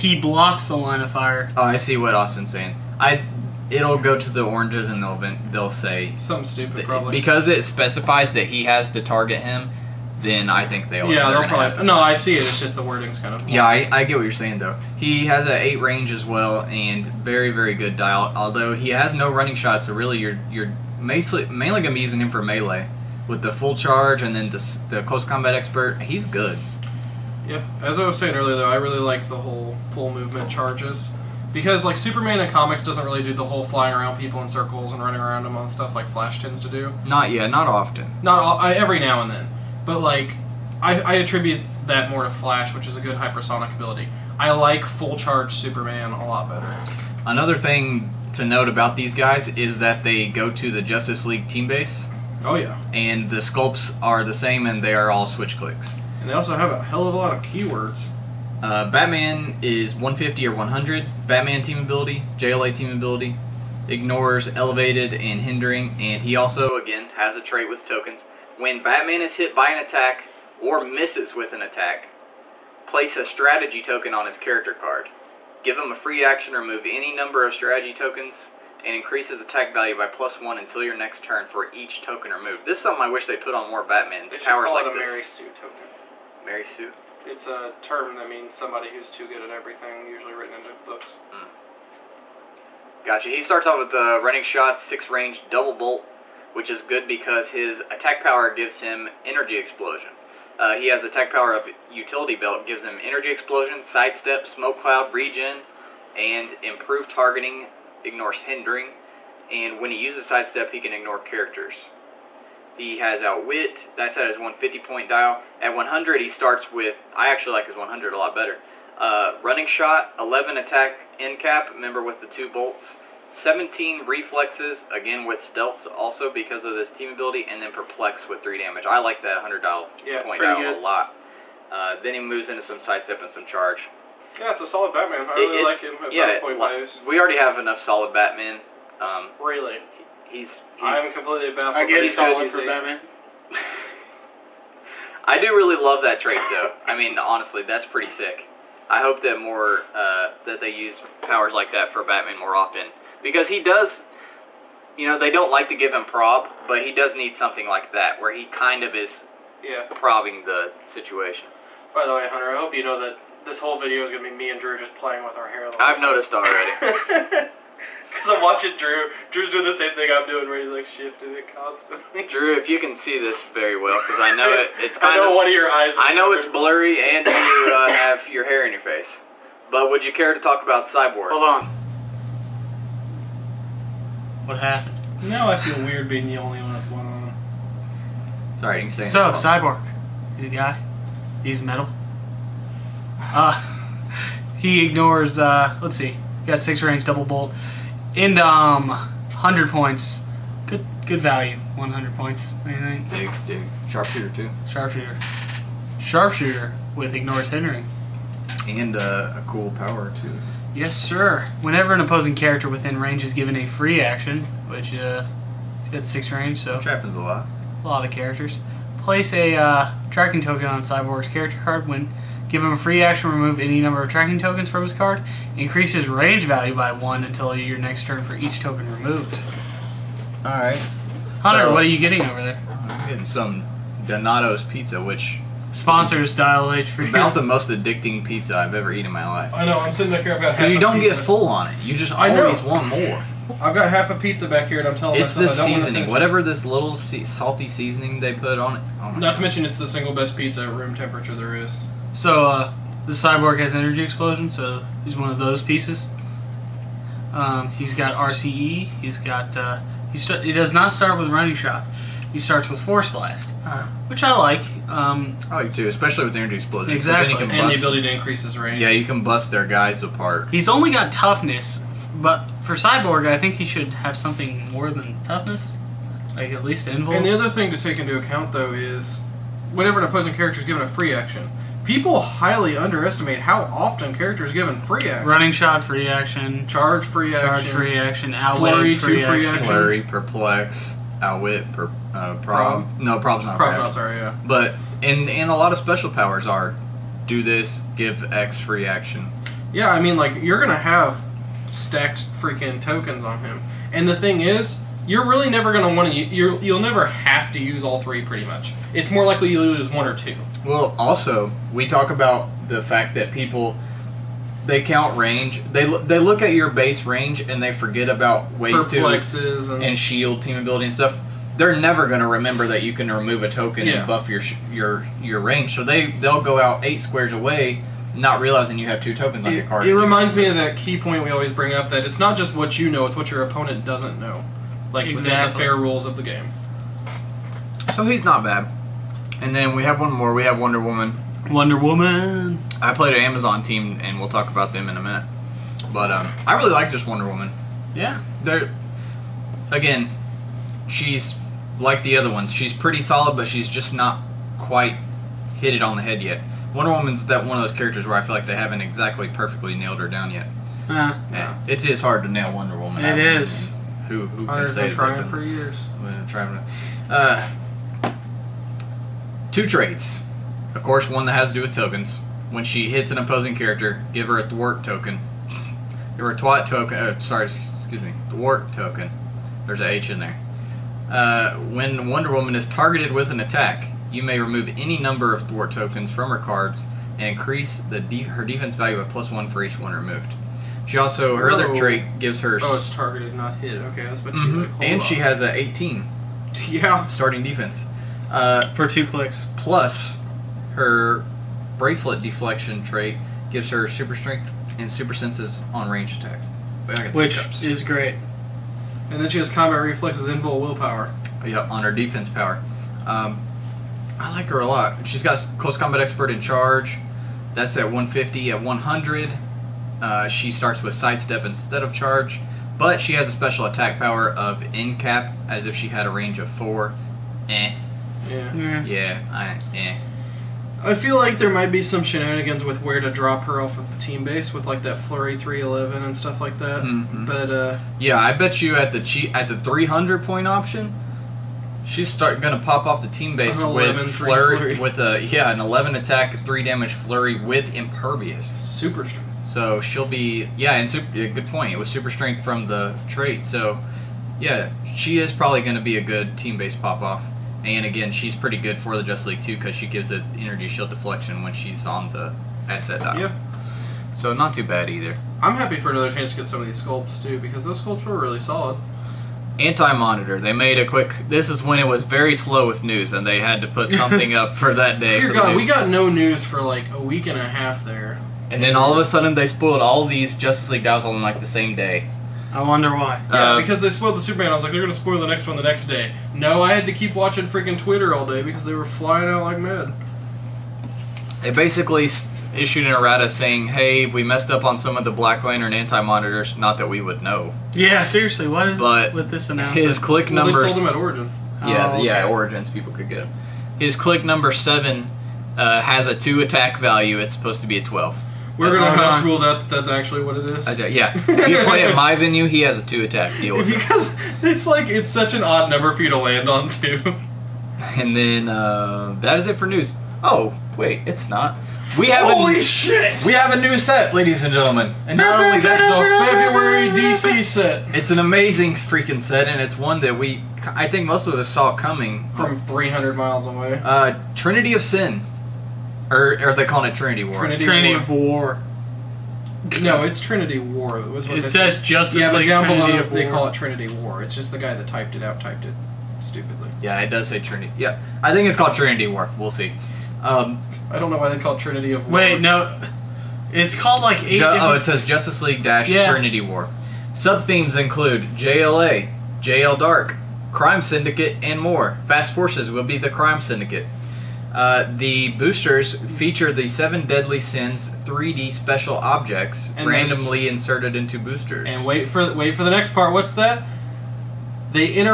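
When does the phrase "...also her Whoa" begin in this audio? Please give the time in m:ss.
6:30.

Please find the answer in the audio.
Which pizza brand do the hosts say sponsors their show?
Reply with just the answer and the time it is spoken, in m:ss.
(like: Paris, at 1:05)
Donato's, at 3:54.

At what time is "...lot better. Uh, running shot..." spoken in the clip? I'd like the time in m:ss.
1:58.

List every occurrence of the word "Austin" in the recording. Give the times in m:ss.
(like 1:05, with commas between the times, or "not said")
0:02.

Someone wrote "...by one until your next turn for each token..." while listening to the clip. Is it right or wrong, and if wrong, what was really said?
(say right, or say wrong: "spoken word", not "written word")
right.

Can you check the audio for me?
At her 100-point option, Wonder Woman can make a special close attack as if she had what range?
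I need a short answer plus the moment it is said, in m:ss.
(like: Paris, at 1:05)
4, at 7:06.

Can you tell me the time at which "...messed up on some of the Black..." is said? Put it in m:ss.
8:14.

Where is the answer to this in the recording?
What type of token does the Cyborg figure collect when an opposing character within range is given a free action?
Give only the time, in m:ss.
3:40.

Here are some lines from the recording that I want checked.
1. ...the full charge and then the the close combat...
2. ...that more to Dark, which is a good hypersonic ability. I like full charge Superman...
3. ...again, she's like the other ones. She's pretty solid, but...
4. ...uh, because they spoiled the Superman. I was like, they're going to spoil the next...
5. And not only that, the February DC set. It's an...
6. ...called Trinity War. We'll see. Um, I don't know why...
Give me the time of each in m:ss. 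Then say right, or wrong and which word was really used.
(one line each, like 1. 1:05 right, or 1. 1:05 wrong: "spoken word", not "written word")
1. 0:23 right
2. 0:41 wrong: "Flash", not "Dark"
3. 5:49 right
4. 8:03 right
5. 8:45 right
6. 9:08 right.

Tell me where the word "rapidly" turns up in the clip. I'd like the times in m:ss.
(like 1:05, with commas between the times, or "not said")
not said.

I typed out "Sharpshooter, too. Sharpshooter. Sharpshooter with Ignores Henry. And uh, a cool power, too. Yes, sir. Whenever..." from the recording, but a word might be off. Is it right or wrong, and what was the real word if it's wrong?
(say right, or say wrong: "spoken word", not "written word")
right.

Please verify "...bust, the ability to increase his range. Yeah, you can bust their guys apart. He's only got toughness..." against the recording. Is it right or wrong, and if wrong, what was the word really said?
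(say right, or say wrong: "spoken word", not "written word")
right.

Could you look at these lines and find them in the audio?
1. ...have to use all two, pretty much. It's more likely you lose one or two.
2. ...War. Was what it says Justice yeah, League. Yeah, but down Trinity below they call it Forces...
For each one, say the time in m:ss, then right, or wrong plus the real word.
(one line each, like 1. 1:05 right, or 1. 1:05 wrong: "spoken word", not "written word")
1. 5:07 wrong: "three", not "two"
2. 9:00 wrong: "Trinity", not "Forces".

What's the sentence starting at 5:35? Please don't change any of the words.
within the fair rules of the game.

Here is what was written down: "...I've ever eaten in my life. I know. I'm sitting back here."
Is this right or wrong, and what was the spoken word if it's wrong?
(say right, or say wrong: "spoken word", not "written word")
right.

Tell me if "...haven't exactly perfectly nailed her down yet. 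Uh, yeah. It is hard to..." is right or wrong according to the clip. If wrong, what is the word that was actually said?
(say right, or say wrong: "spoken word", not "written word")
right.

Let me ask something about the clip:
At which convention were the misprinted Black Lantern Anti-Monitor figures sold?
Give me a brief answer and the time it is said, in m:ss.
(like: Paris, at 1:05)
Origins, at 8:20.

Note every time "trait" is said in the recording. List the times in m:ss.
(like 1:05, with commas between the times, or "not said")
1:07, 2:26, 6:09, 6:31, 6:42, 7:33.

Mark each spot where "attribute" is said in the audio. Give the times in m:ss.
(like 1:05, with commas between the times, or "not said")
0:41.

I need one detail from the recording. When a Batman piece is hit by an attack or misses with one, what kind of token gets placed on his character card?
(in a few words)
strategy token.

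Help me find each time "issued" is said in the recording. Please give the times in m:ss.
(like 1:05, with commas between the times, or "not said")
8:12.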